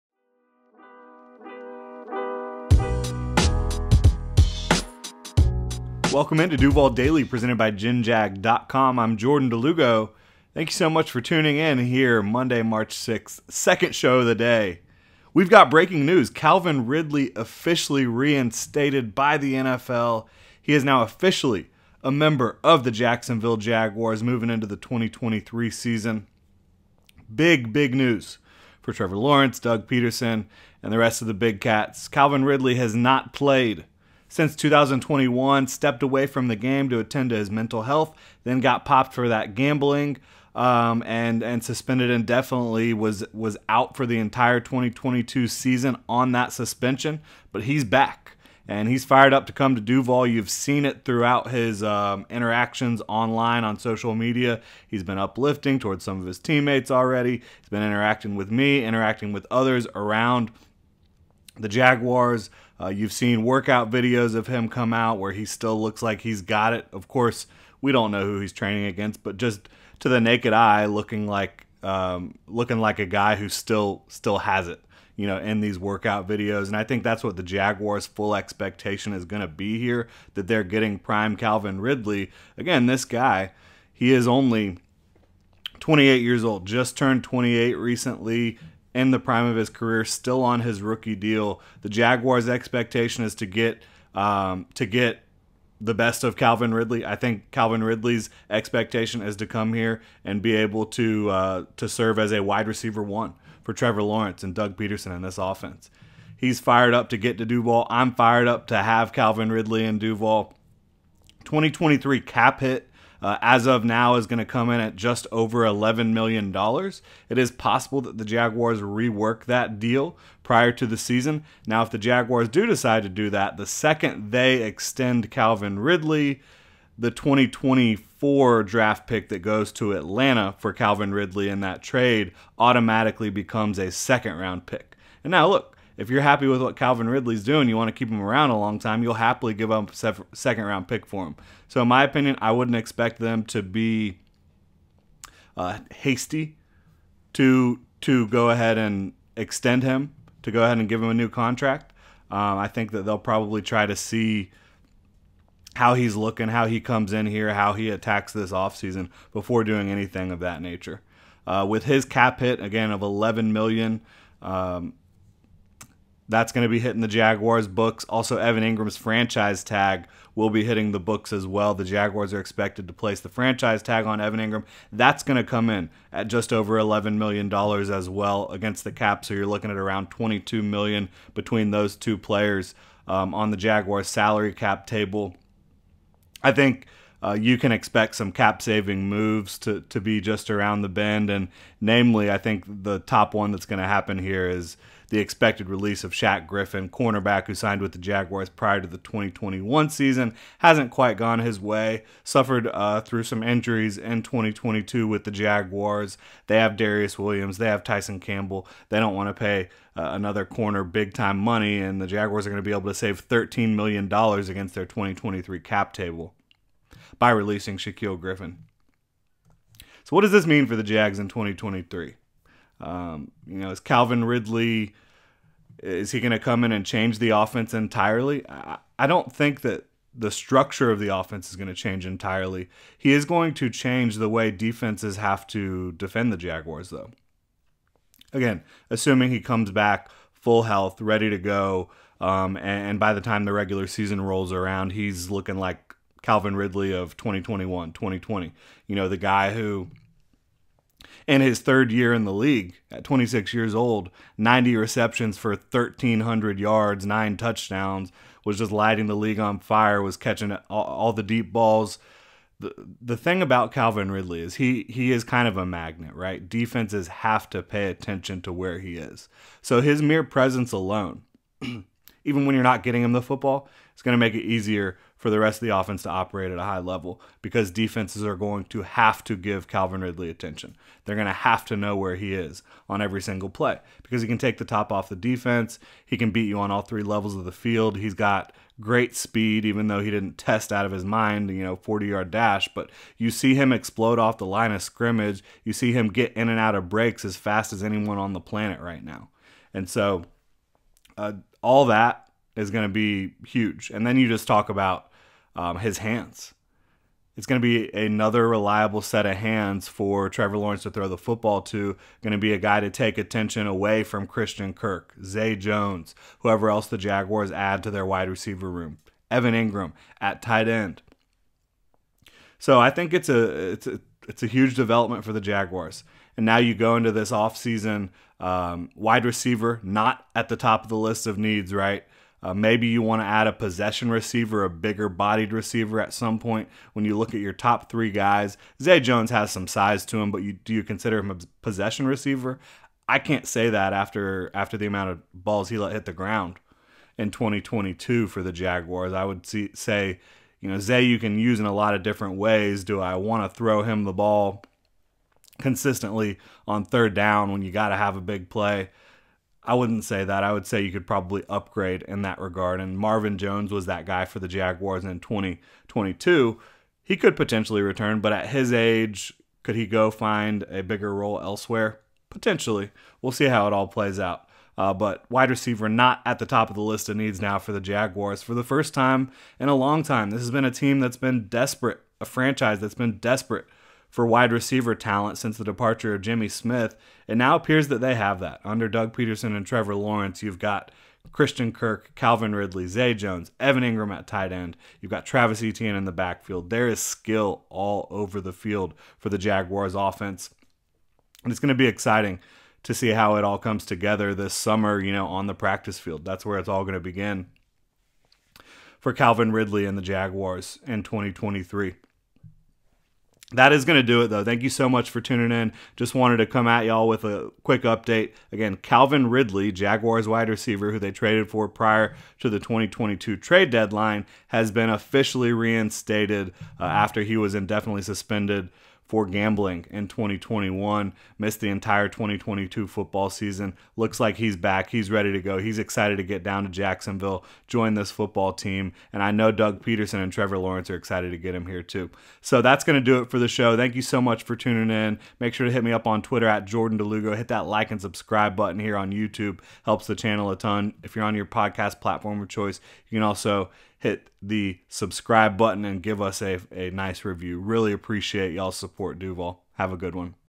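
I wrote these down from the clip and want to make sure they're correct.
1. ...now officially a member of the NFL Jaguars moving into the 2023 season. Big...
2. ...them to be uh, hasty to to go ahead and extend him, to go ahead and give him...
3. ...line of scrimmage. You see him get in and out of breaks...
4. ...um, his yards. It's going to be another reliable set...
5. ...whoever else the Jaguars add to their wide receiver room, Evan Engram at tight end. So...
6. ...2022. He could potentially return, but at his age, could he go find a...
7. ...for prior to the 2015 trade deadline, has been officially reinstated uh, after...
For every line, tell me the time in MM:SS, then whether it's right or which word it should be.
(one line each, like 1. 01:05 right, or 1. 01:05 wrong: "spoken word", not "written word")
1. 00:20 wrong: "Jacksonville", not "NFL"
2. 02:23 right
3. 04:54 right
4. 05:05 wrong: "hands", not "yards"
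5. 05:16 right
6. 06:05 right
7. 07:01 wrong: "2022", not "2015".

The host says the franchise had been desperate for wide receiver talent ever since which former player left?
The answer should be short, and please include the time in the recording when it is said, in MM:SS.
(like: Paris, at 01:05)
Jimmy Smith, at 06:26.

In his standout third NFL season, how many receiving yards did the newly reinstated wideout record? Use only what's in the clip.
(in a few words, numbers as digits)
1,300.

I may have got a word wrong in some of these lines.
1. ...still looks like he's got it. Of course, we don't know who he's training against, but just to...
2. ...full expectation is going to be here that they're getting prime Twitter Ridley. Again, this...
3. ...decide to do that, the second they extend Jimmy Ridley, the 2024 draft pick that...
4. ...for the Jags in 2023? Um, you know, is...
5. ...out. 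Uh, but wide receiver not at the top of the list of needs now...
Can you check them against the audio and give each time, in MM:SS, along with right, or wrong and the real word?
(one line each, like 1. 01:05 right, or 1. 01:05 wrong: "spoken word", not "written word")
1. 01:05 right
2. 01:18 wrong: "Calvin", not "Twitter"
3. 02:02 wrong: "Calvin", not "Jimmy"
4. 03:40 right
5. 06:14 right.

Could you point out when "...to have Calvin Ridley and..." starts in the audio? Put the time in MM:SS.
01:48.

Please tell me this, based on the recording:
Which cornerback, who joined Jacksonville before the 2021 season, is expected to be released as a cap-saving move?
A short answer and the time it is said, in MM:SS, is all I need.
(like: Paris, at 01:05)
Shaq Griffin, at 03:16.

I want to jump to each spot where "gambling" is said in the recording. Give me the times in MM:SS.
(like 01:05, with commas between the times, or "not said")
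00:39, 07:09.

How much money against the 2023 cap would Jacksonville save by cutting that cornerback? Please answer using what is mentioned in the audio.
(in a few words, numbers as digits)
$13 million.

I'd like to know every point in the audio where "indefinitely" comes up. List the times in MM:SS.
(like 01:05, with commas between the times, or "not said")
00:42, 07:07.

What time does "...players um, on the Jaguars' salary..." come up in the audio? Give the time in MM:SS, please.
03:02.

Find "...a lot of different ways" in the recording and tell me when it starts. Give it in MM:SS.
05:51.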